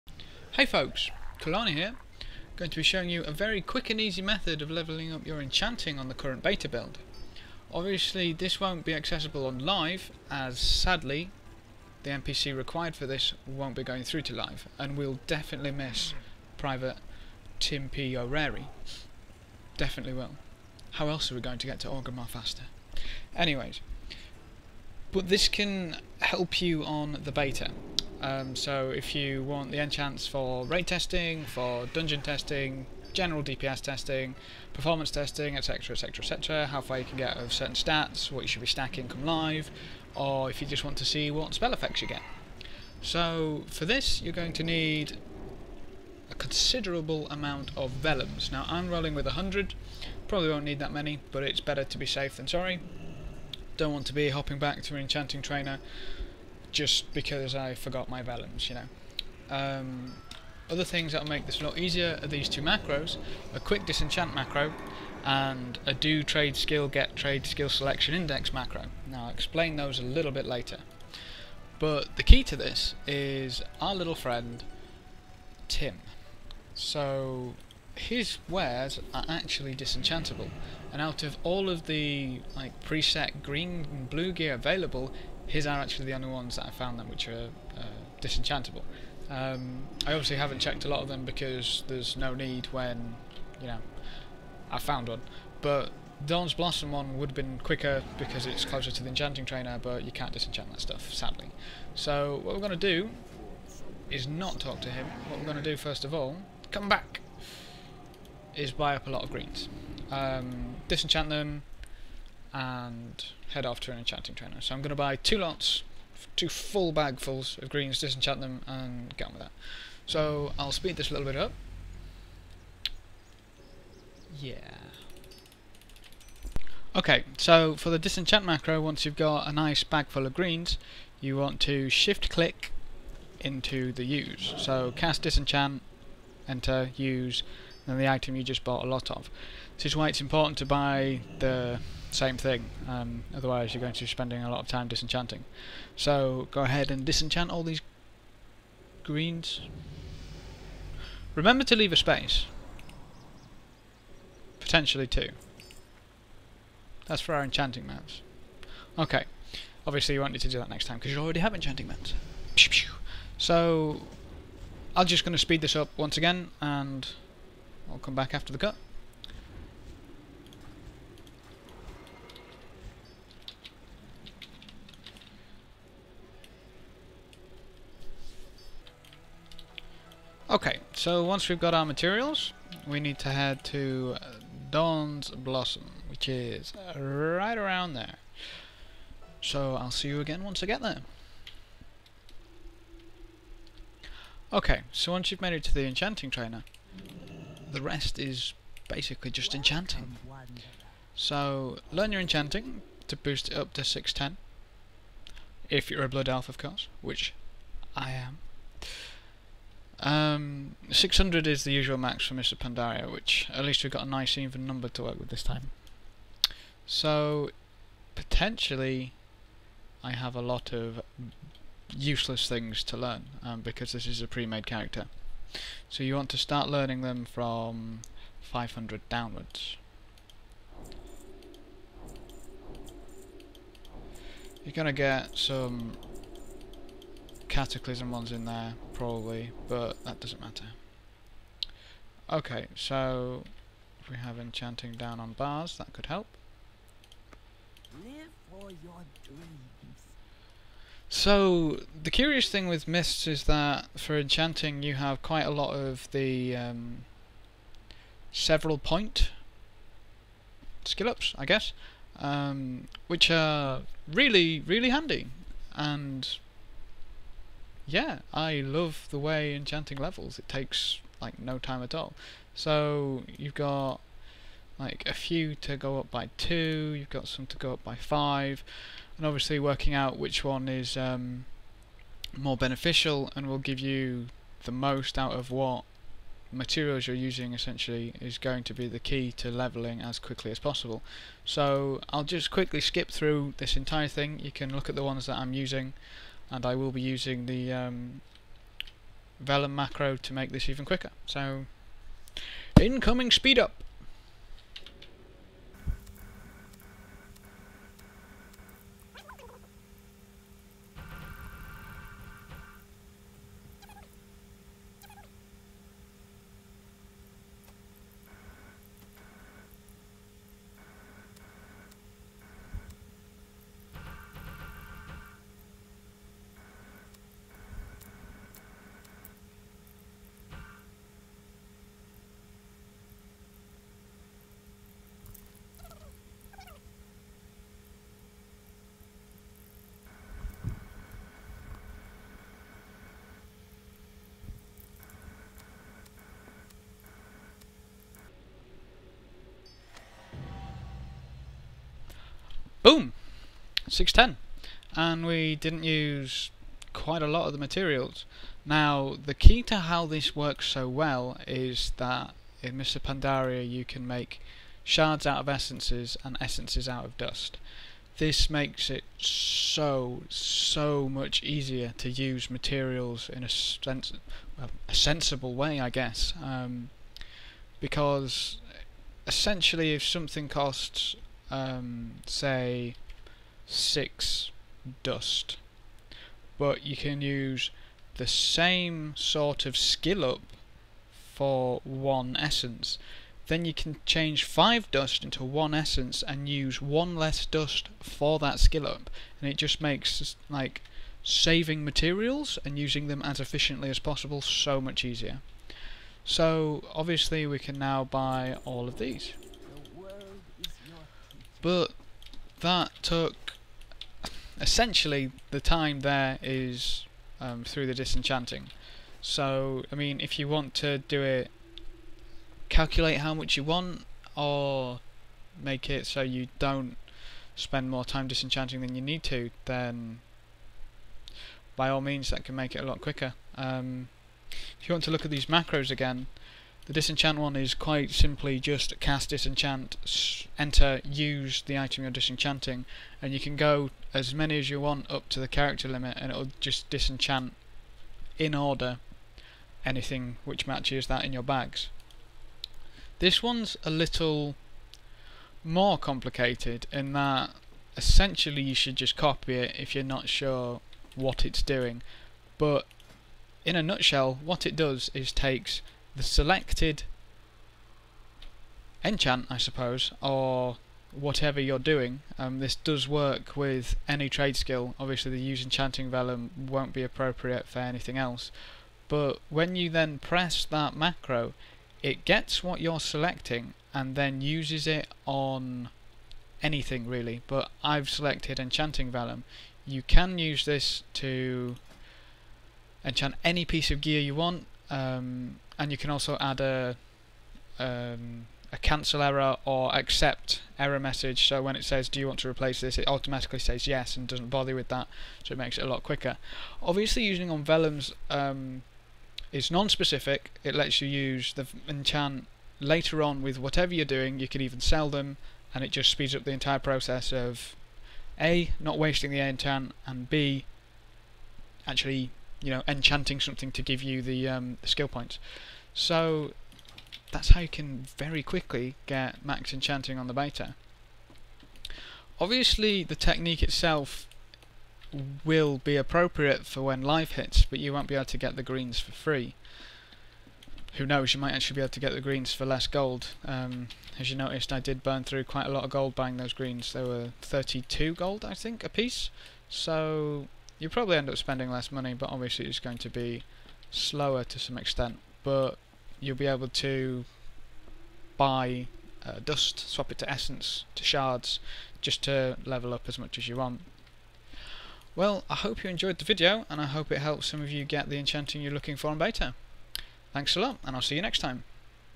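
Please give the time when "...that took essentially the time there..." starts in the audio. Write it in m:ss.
6:52.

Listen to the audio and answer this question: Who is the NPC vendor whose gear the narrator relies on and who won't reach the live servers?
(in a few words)
Private Tim P. O'Reary.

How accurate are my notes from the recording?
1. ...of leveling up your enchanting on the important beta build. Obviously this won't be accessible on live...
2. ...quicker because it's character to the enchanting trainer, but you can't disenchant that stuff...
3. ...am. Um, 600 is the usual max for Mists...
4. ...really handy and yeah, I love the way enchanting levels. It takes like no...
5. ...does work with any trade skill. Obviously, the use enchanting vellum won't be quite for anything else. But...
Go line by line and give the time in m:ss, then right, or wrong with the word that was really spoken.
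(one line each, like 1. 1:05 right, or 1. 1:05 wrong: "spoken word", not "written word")
1. 0:04 wrong: "current", not "important"
2. 1:37 wrong: "closer", not "character"
3. 3:28 right
4. 4:24 right
5. 7:52 wrong: "appropriate", not "quite".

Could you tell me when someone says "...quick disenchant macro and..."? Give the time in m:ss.
1:03.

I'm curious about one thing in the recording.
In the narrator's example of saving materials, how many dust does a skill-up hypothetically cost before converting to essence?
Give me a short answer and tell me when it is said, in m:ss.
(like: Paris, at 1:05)
6, at 6:23.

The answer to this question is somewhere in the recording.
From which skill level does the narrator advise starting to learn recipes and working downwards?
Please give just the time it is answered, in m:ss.
3:48.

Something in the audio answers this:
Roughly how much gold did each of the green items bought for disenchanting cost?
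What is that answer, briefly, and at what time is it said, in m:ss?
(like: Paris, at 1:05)
32 gold, at 9:07.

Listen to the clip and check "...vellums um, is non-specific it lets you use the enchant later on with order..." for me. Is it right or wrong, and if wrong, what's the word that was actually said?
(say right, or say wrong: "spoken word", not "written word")
wrong: "whatever", not "order".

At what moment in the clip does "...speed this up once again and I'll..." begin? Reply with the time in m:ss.
2:45.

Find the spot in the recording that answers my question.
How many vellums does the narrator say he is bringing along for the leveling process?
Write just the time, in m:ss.
0:49.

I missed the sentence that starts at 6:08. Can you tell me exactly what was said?
This makes it so, so much easier to use materials in a, sens a sensible way, I guess.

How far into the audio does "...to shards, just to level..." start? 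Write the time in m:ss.
9:20.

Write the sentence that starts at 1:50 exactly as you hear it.
Um, disenchant them, and head off to an enchanting trainer.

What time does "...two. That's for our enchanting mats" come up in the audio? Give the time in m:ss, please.
2:35.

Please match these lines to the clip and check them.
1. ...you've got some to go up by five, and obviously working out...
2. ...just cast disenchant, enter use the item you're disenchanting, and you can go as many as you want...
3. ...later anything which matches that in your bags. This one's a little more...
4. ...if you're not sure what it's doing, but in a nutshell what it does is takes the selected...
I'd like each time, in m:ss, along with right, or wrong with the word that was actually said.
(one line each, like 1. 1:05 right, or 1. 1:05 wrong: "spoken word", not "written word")
1. 4:36 right
2. 7:18 right
3. 7:28 wrong: "order", not "later"
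4. 7:39 right.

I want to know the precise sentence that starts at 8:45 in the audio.
So that's how you can very quickly get max enchanting on the beta.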